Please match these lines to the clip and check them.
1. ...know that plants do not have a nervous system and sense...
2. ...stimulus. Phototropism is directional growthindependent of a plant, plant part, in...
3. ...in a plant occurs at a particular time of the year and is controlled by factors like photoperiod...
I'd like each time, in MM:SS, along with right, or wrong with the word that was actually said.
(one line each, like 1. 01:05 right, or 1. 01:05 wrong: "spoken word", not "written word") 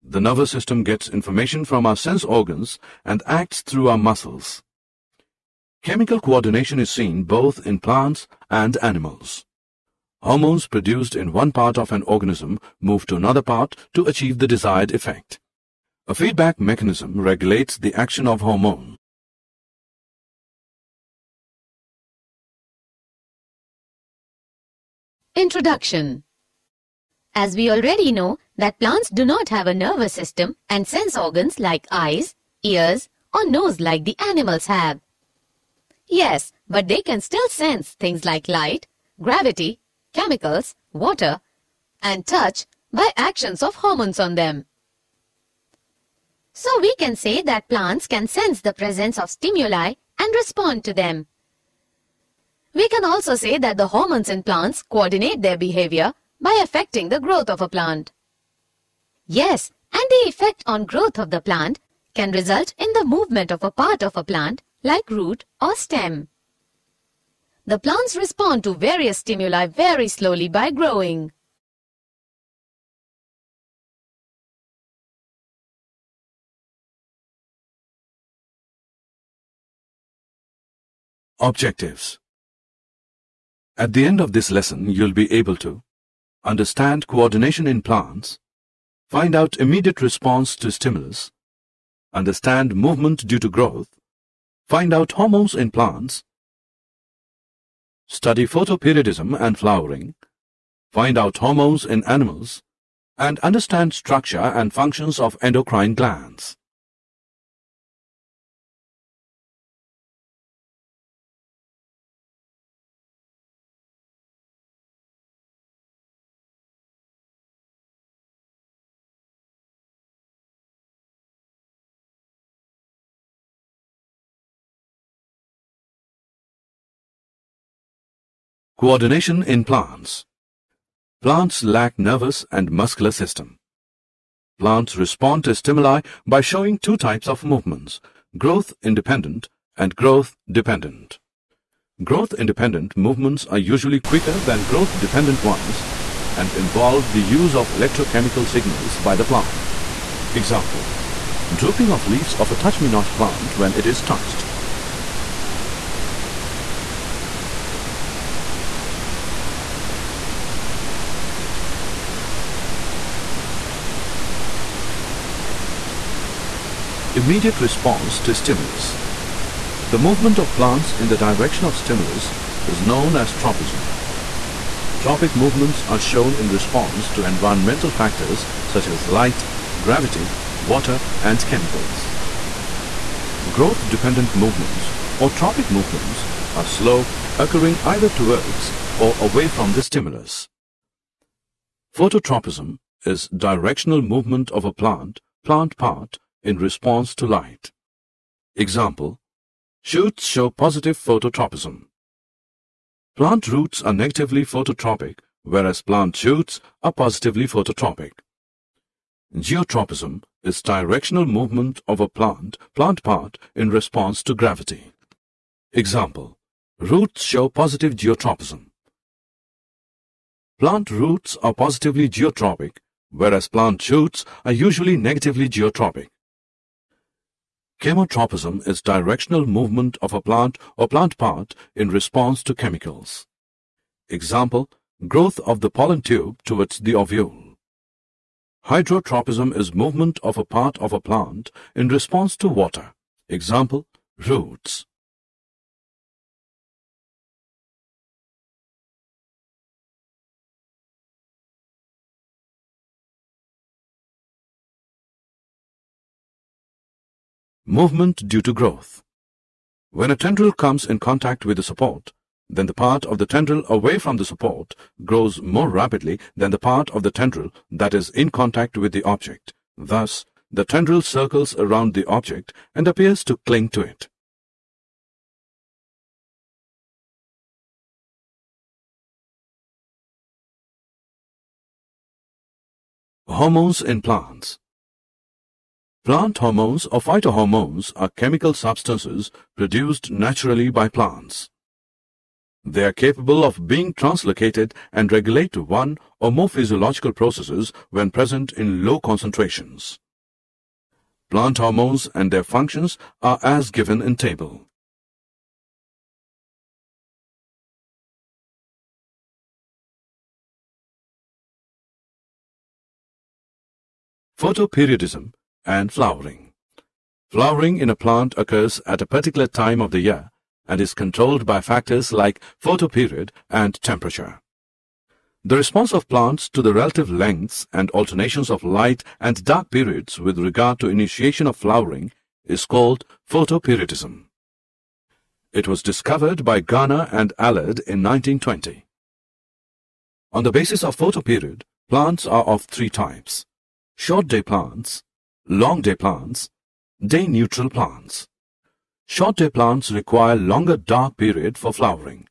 1. 00:28 right
2. 03:09 wrong: "movement", not "growthindependent"
3. 05:17 right.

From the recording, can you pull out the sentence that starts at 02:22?
Growth-independent movements are usually quicker than growth-dependent ones and involve the use of electrochemical signals by the plant.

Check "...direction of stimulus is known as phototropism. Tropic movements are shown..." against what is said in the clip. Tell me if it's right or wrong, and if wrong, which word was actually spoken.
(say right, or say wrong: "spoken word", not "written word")
wrong: "tropism", not "phototropism".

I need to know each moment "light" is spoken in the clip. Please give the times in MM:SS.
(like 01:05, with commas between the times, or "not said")
00:38, 02:59, 03:17, 05:28.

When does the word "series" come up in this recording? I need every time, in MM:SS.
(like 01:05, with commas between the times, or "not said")
not said.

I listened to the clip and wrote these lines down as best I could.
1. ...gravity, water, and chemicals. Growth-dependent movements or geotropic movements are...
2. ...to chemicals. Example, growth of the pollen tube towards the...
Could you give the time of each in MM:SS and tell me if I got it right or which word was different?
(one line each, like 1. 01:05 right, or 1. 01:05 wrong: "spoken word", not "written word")
1. 02:59 wrong: "tropic", not "geotropic"
2. 03:52 right.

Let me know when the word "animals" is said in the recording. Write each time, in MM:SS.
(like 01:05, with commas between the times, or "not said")
00:08, 00:34, 01:42.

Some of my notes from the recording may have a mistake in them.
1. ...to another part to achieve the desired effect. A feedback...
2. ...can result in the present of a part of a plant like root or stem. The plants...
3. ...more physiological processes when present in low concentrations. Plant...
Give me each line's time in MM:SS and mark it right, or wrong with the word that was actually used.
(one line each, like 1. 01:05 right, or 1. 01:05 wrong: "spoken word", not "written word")
1. 00:13 right
2. 01:02 wrong: "movement", not "present"
3. 04:56 right.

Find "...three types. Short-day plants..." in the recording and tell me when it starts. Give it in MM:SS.
05:42.